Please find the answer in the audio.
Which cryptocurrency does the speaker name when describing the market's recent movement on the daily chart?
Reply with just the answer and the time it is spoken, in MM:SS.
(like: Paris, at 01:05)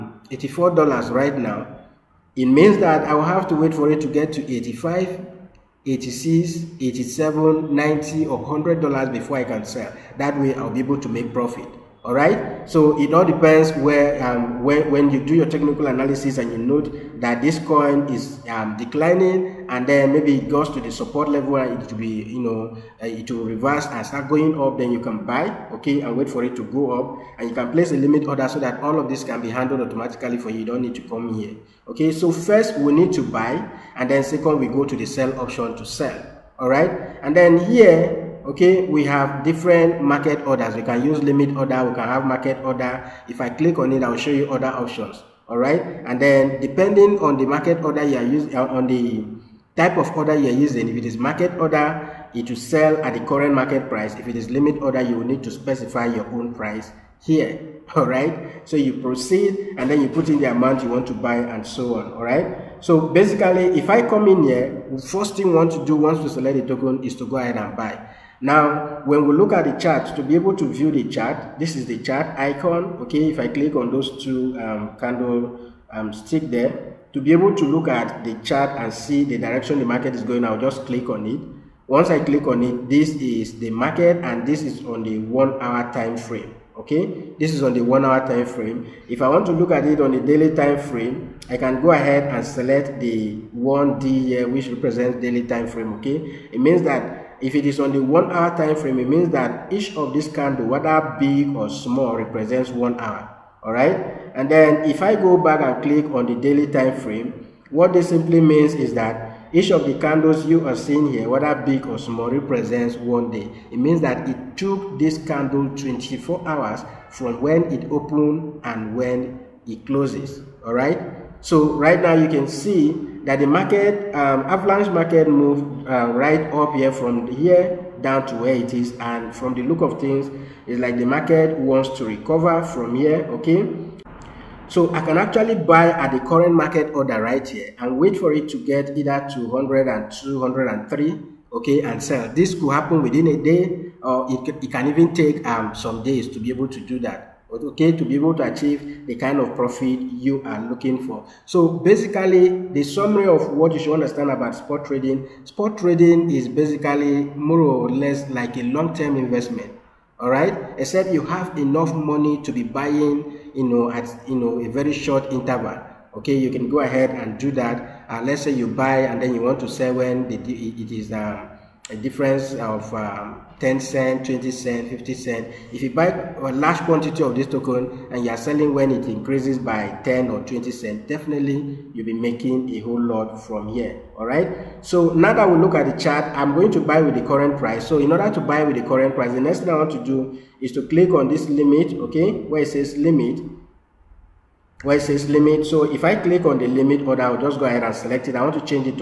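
Avalanche, at 02:04.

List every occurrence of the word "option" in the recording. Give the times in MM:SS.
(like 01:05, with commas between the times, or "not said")
00:35, 00:44.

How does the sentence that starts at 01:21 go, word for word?
Once I click on it, this is the market and this is on the one hour time frame.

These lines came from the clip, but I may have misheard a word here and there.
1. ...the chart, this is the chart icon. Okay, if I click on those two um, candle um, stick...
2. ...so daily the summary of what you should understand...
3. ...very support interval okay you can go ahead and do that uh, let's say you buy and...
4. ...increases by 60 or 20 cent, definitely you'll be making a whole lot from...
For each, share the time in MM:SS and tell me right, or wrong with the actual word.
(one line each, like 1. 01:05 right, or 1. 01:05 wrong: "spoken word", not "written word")
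1. 01:10 right
2. 02:31 wrong: "basically", not "daily"
3. 02:44 wrong: "short", not "support"
4. 02:59 wrong: "10", not "60".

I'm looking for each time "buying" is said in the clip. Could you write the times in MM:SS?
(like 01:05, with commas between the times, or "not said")
02:42.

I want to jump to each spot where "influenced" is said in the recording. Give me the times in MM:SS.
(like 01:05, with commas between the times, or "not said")
not said.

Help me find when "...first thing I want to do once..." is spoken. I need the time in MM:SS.
01:05.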